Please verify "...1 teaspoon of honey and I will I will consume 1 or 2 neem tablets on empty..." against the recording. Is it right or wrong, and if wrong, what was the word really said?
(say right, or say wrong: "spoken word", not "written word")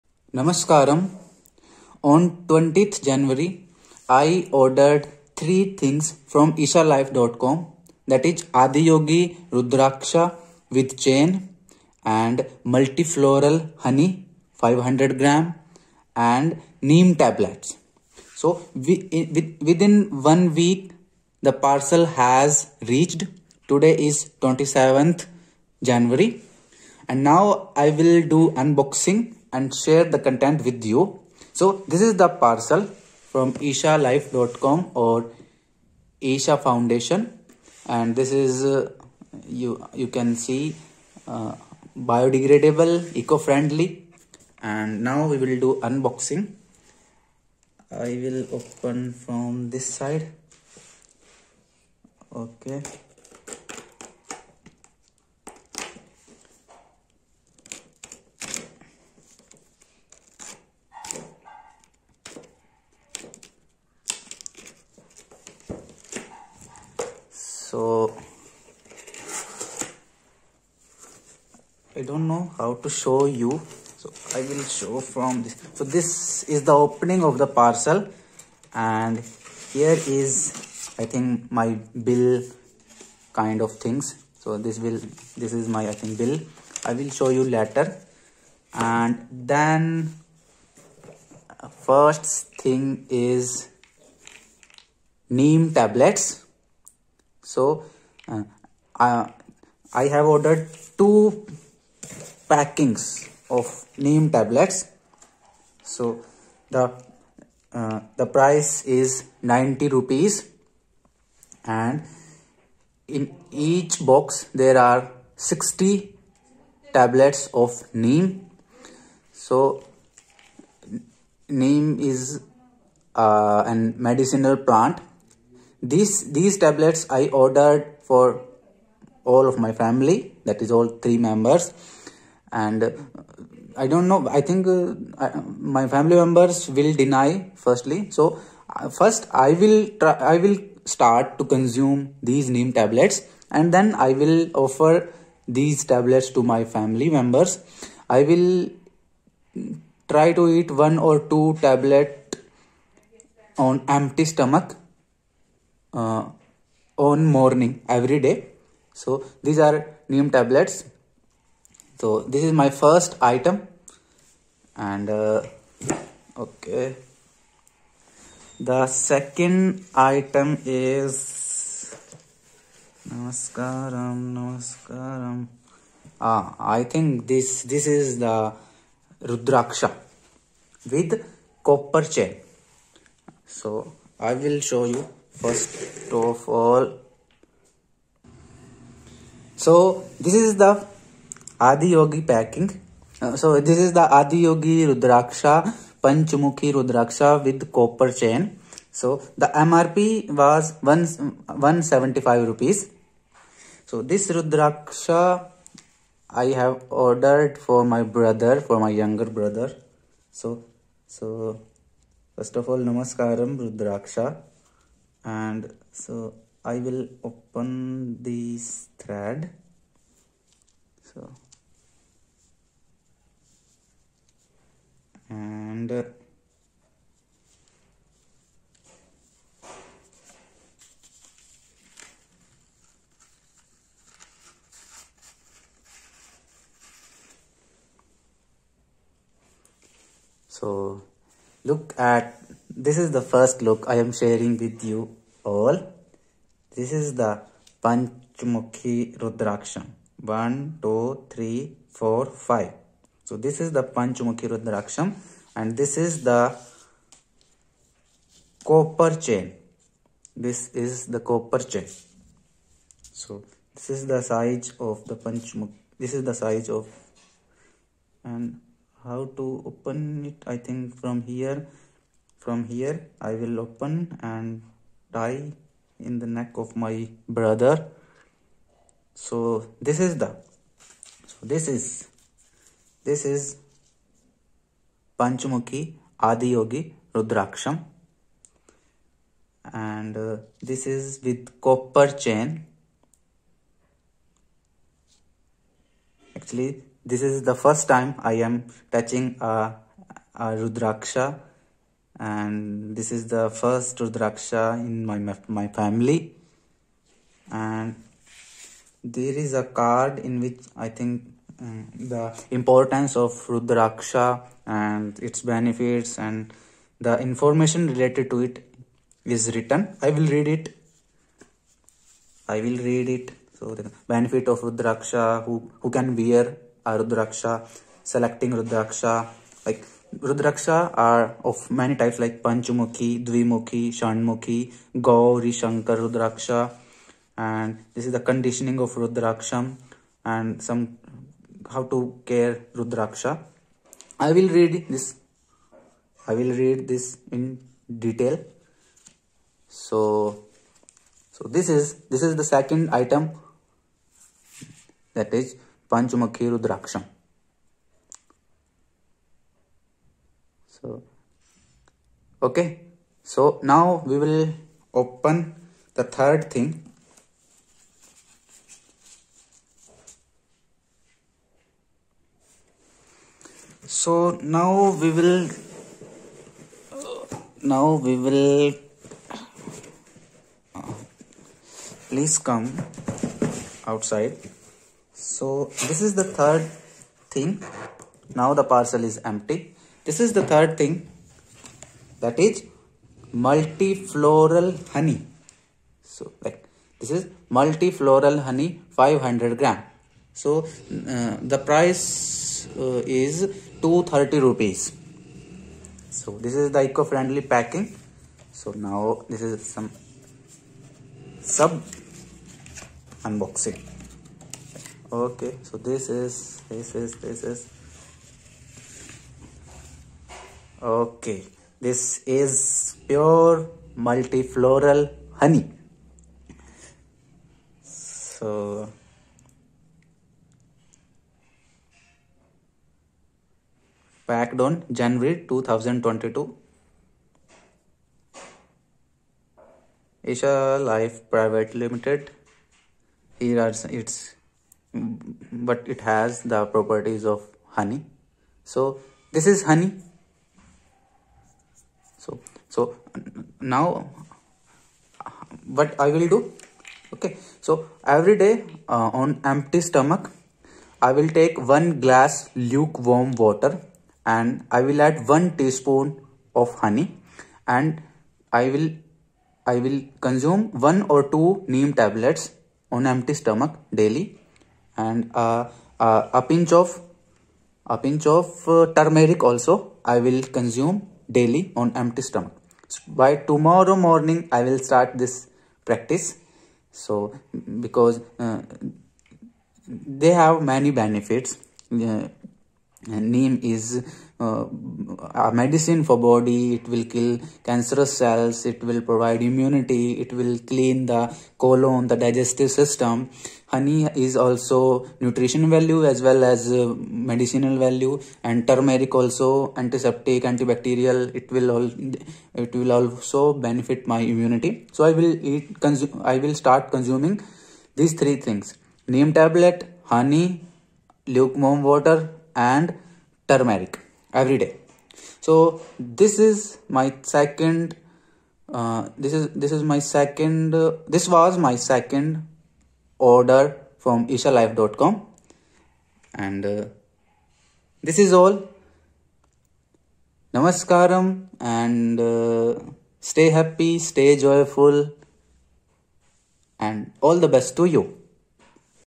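right.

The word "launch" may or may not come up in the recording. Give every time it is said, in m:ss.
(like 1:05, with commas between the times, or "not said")
not said.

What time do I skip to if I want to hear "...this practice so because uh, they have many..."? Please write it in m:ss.
8:05.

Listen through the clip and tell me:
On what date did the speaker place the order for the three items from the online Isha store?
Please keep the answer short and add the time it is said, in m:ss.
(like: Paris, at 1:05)
20th January, at 0:02.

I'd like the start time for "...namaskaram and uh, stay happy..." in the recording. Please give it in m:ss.
9:00.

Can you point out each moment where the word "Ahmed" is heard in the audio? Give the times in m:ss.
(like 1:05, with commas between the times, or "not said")
not said.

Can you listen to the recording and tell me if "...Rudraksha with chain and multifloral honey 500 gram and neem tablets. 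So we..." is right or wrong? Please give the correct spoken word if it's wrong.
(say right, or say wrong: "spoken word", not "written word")
right.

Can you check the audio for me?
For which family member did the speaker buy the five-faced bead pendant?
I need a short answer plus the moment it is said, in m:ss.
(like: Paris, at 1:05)
younger brother, at 3:28.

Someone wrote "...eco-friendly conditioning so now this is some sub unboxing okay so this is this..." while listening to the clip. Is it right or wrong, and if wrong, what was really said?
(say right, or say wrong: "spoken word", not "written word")
wrong: "packing", not "conditioning".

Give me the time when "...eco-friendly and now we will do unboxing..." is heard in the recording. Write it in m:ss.
0:43.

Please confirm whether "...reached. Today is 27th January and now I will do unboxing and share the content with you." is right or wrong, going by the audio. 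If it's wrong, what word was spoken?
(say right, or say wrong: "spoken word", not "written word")
right.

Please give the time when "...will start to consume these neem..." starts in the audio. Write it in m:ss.
2:20.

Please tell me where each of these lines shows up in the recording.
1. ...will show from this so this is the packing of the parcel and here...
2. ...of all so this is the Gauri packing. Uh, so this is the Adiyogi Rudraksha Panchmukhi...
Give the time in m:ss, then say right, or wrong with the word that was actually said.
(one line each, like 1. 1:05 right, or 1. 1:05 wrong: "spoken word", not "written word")
1. 1:14 wrong: "opening", not "packing"
2. 3:06 wrong: "Adiyogi", not "Gauri".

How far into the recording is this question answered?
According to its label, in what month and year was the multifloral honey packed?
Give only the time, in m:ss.
7:14.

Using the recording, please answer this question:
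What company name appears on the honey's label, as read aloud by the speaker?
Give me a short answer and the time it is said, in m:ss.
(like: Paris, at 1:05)
Isha Life Private Limited, at 7:20.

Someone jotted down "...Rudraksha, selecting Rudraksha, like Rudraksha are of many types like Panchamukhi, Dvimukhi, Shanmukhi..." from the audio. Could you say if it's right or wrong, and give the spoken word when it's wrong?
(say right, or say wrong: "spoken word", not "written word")
right.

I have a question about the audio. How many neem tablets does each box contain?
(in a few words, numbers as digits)
60.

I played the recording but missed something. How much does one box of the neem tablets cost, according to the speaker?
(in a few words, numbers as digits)
90 rupees.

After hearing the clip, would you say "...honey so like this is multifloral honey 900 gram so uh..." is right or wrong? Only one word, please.
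wrong.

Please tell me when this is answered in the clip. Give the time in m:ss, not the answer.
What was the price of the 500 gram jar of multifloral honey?
6:43.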